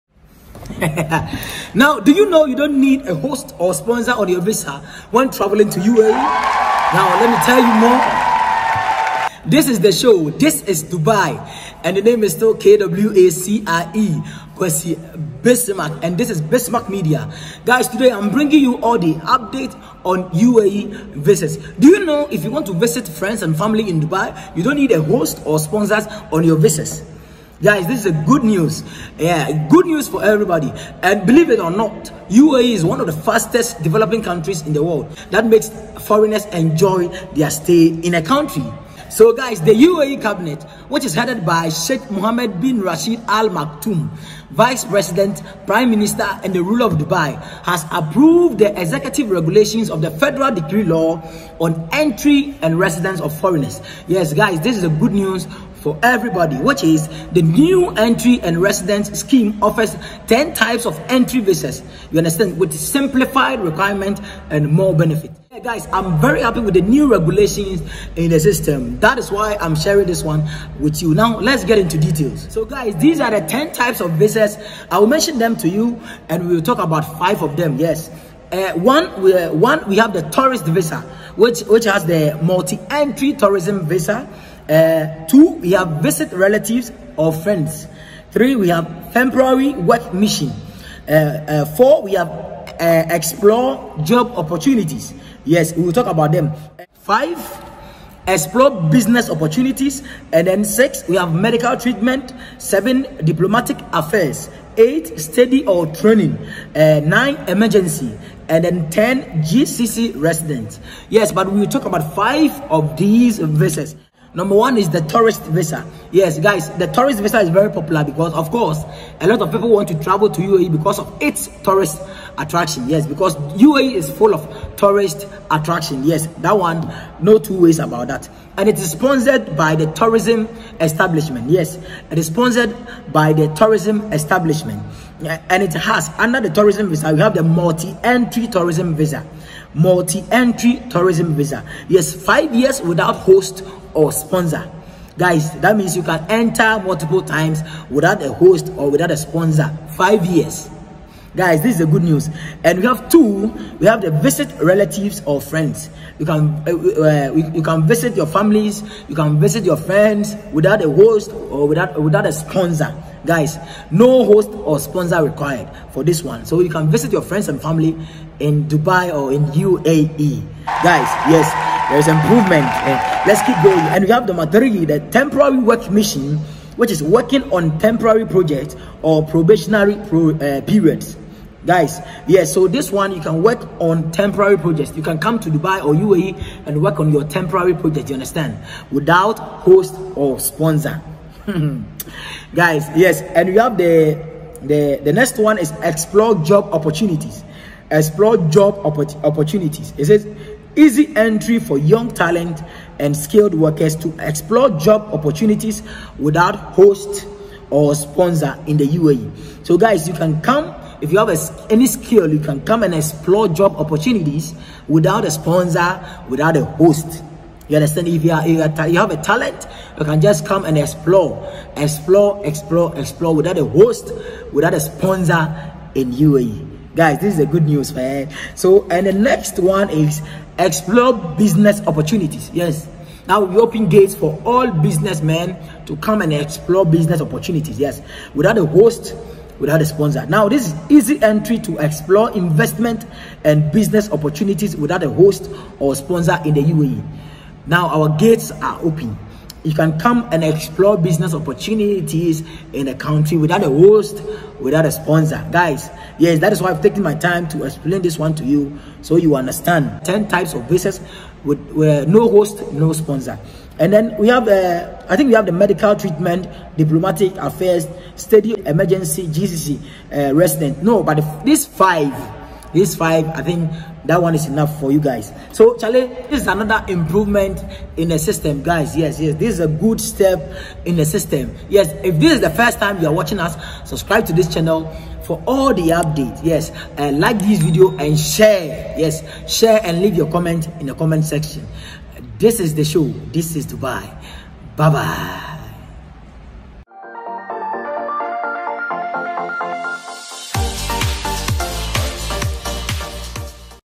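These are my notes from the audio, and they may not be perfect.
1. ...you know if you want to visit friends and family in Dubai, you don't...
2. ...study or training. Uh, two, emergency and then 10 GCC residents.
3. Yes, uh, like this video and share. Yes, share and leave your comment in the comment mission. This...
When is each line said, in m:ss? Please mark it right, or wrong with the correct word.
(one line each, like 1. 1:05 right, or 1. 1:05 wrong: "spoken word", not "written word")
1. 0:21 right
2. 1:45 wrong: "nine", not "two"
3. 4:46 wrong: "section", not "mission".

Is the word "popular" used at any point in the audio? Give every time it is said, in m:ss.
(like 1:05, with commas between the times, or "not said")
1:57.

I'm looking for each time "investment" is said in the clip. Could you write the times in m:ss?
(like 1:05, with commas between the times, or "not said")
4:02.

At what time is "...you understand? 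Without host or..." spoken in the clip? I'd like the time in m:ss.
3:08.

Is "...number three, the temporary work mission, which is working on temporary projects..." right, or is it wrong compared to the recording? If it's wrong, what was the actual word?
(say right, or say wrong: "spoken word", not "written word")
right.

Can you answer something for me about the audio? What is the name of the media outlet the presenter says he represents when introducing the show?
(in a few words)
Bismark Media.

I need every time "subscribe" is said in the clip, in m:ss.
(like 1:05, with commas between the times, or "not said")
4:43.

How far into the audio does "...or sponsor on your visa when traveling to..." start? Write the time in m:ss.
0:03.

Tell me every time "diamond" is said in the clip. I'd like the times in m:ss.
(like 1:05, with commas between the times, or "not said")
not said.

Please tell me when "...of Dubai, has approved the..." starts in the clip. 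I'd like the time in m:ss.
0:46.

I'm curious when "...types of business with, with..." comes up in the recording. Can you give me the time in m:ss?
4:20.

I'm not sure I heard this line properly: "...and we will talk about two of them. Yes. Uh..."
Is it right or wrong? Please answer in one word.
wrong.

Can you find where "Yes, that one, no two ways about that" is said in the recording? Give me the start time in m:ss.
2:06.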